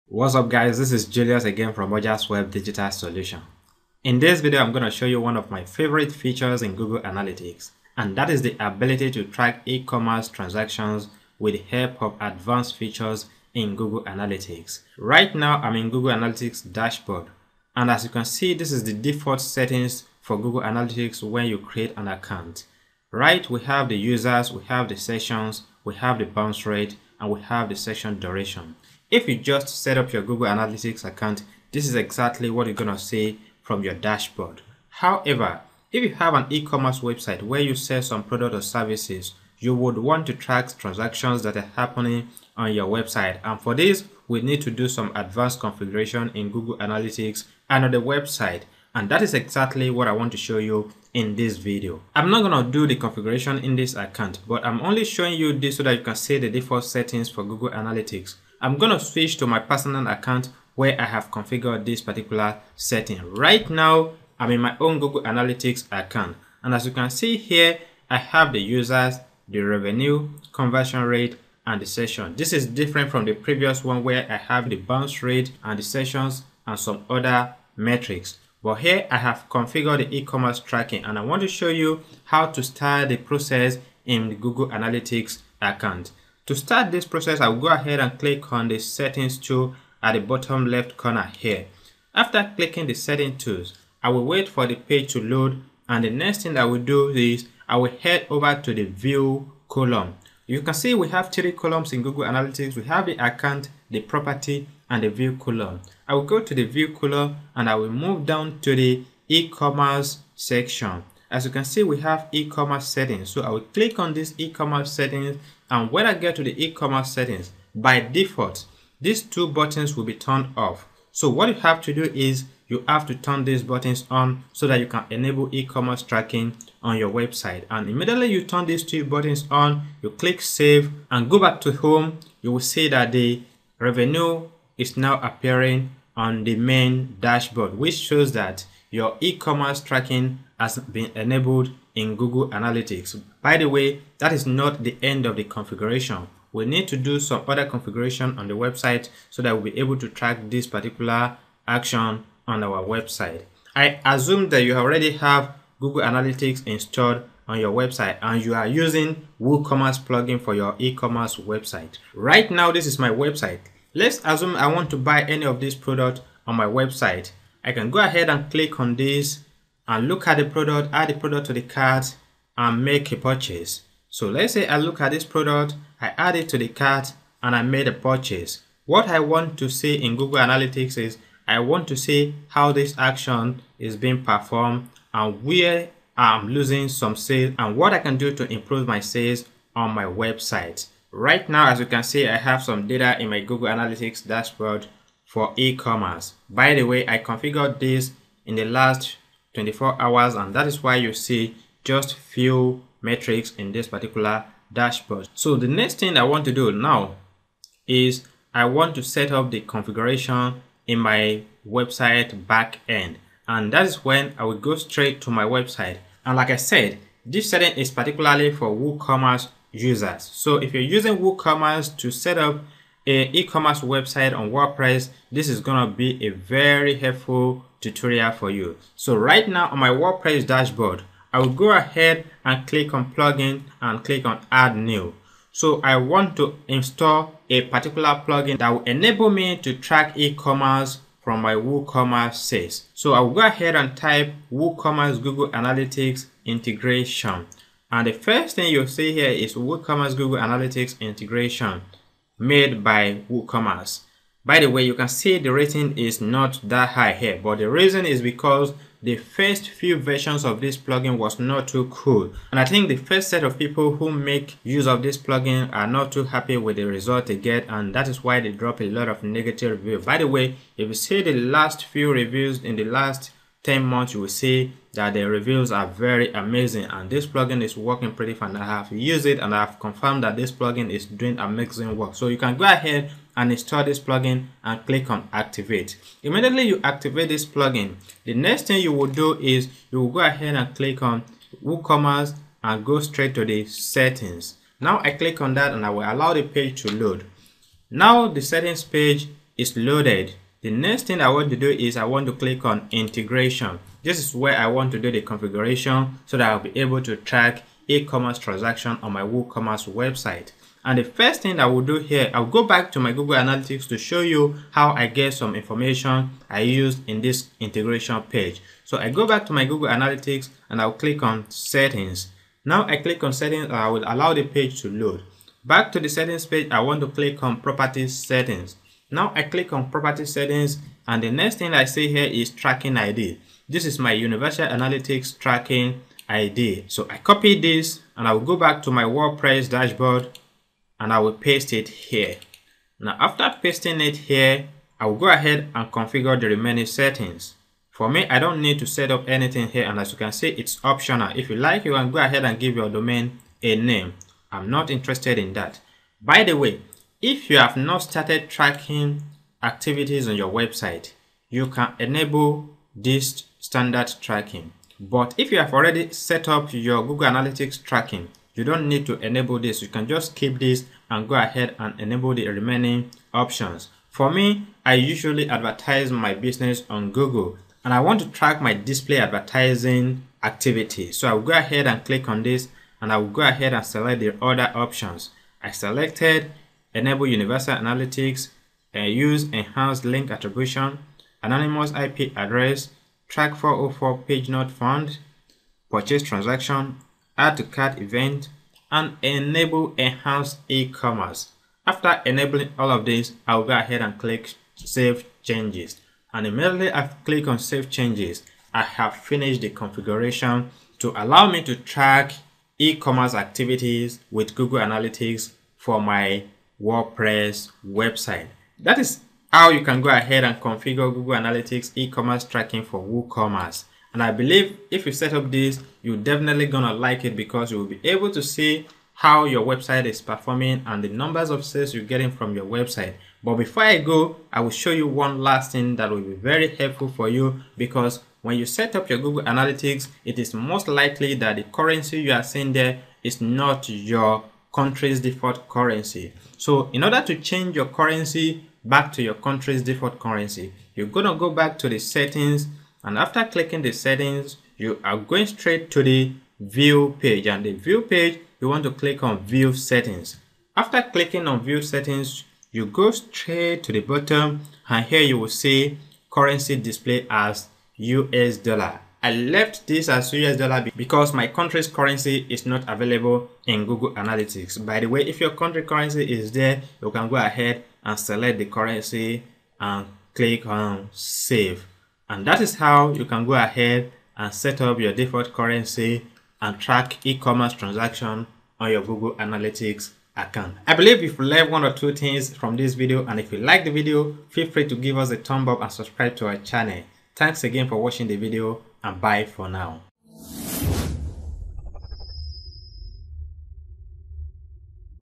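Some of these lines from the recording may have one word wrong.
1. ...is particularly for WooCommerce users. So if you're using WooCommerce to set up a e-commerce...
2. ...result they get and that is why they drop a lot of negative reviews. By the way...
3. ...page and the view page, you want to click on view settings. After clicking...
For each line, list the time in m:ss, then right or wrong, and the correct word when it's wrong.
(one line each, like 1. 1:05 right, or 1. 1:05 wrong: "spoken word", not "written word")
1. 3:37 right
2. 4:26 right
3. 7:37 right.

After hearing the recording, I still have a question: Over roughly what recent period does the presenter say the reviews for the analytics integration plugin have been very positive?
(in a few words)
10 months.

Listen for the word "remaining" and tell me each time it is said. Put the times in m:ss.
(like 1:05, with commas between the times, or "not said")
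5:46, 6:12.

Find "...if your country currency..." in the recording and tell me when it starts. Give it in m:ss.
7:55.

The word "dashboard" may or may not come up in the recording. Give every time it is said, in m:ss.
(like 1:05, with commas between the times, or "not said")
0:16, 0:33, 2:17, 3:14, 3:24, 3:50, 5:39.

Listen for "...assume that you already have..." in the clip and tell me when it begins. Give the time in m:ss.
2:34.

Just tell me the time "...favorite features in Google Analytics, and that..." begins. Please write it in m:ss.
0:05.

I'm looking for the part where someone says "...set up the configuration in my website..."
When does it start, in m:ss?
3:29.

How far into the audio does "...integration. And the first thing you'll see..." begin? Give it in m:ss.
4:06.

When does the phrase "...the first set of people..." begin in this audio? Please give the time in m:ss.
4:22.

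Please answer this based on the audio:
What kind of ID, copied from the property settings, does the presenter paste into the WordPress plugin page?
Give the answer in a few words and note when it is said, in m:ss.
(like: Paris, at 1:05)
Universal Analytics tracking ID, at 5:34.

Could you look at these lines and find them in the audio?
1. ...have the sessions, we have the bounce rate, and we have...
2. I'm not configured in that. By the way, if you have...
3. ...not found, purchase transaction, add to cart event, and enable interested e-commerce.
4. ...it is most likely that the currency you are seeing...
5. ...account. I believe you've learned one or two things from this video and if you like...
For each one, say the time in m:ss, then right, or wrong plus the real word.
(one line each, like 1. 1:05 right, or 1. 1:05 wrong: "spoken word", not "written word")
1. 0:24 right
2. 5:54 wrong: "interested", not "configured"
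3. 6:34 wrong: "enhanced", not "interested"
4. 7:20 right
5. 8:10 right.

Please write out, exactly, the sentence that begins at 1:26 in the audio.
To start this process, I'll go ahead and click on the settings tool at the bottom left corner here.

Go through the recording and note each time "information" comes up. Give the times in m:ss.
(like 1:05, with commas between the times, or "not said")
5:15.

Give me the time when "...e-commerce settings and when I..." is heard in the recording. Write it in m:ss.
1:54.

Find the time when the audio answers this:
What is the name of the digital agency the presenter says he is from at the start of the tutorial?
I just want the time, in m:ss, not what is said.
0:01.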